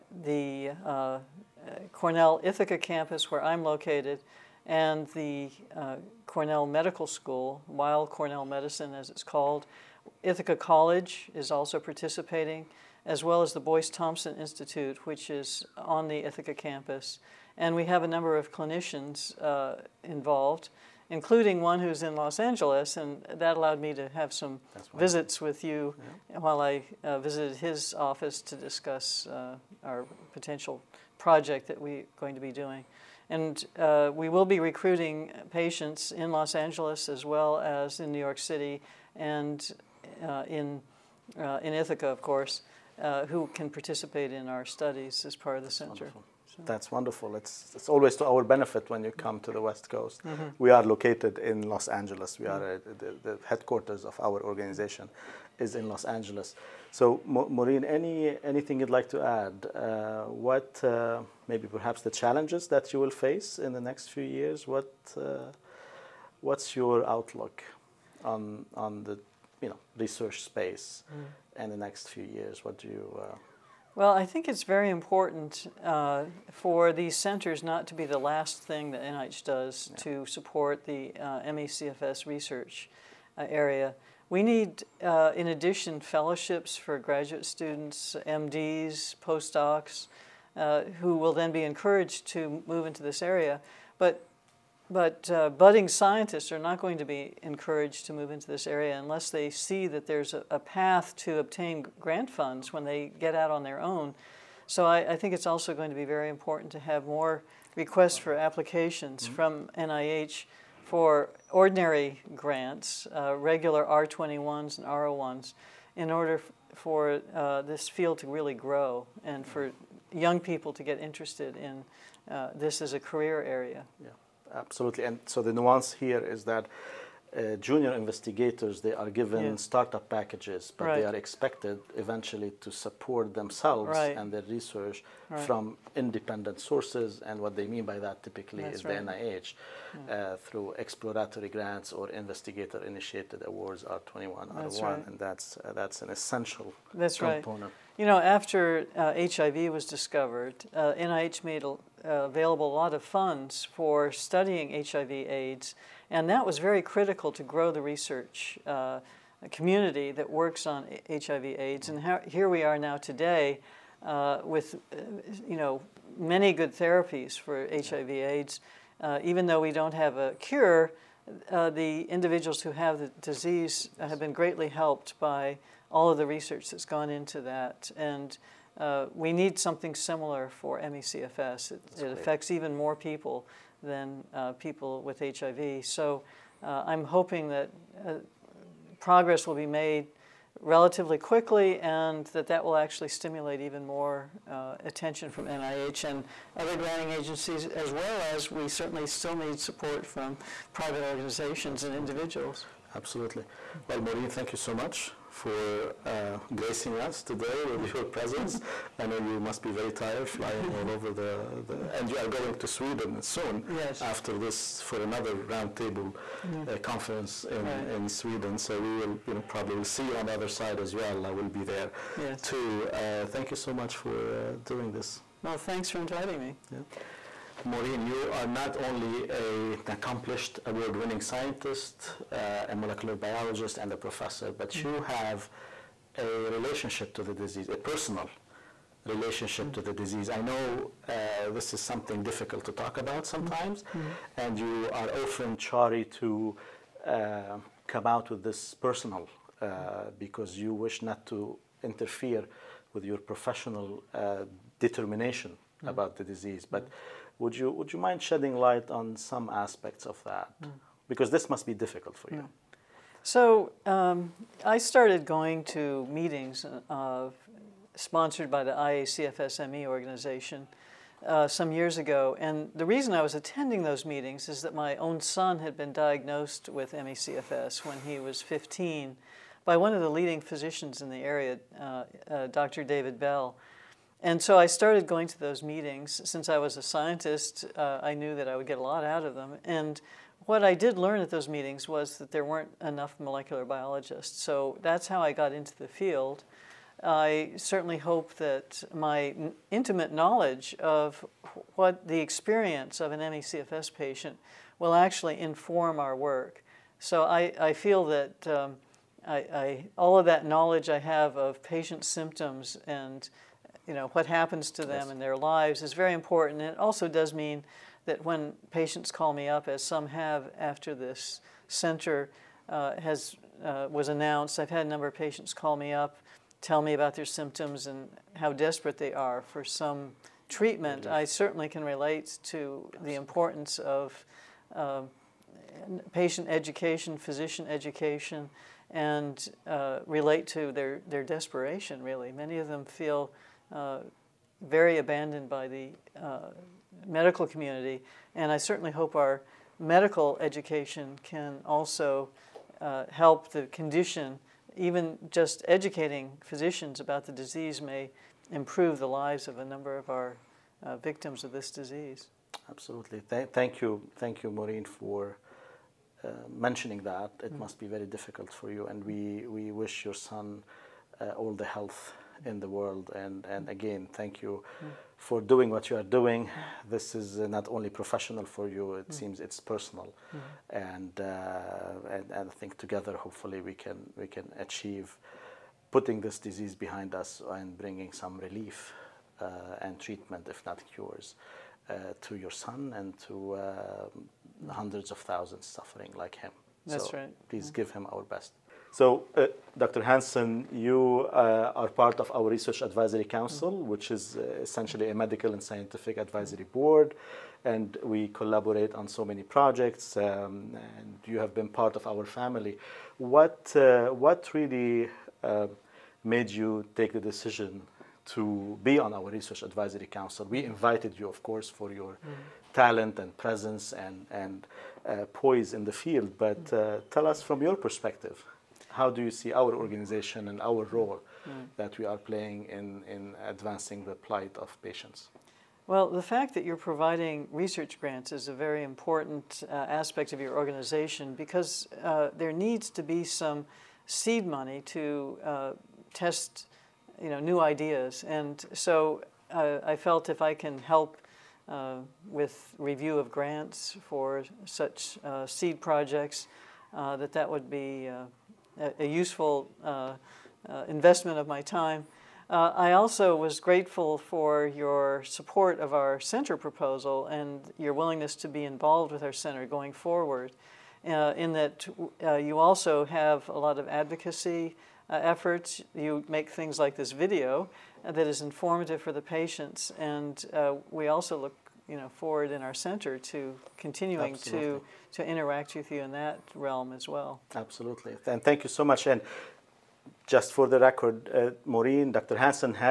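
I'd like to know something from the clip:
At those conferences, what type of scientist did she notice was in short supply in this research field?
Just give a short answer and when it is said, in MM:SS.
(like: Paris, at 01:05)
Molecular biologists, at 04:53.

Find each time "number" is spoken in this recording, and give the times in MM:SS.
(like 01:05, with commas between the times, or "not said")
00:18, 05:24, 05:59.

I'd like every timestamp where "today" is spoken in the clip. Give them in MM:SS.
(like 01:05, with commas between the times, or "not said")
02:42, 03:27.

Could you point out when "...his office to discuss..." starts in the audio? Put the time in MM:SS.
00:27.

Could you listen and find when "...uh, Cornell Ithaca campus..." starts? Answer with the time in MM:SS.
00:00.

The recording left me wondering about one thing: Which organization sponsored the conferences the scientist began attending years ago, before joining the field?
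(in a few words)
IACFSME.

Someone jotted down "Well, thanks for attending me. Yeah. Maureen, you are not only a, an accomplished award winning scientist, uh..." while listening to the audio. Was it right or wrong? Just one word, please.
wrong.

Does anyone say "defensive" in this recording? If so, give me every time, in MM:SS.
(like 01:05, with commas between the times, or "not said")
not said.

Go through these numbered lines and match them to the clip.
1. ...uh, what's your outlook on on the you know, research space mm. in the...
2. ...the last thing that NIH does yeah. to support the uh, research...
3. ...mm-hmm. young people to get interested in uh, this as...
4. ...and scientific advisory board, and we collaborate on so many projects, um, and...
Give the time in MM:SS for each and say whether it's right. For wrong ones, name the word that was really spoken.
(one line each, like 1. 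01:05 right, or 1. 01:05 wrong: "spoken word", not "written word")
1. 01:05 right
2. 01:18 right
3. 01:59 right
4. 06:45 right.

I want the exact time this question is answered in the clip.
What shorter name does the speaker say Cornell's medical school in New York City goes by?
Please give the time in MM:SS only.
00:08.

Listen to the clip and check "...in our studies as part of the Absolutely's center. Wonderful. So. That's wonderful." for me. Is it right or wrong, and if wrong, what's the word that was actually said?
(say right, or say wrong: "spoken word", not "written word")
wrong: "That", not "Absolutely".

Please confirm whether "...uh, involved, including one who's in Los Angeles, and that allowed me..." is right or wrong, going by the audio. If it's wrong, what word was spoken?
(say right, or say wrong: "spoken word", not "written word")
right.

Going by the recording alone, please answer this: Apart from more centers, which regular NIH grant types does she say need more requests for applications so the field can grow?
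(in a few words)
R21s and R01s.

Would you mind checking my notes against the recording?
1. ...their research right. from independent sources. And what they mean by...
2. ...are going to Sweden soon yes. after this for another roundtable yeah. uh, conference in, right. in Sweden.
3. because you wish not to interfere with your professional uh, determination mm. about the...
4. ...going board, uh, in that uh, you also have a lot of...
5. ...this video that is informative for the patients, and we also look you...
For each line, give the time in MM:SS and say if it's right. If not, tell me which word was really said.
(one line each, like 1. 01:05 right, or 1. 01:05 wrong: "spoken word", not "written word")
1. 02:14 right
2. 03:32 right
3. 04:10 right
4. 07:49 wrong: "forward", not "board"
5. 07:56 right.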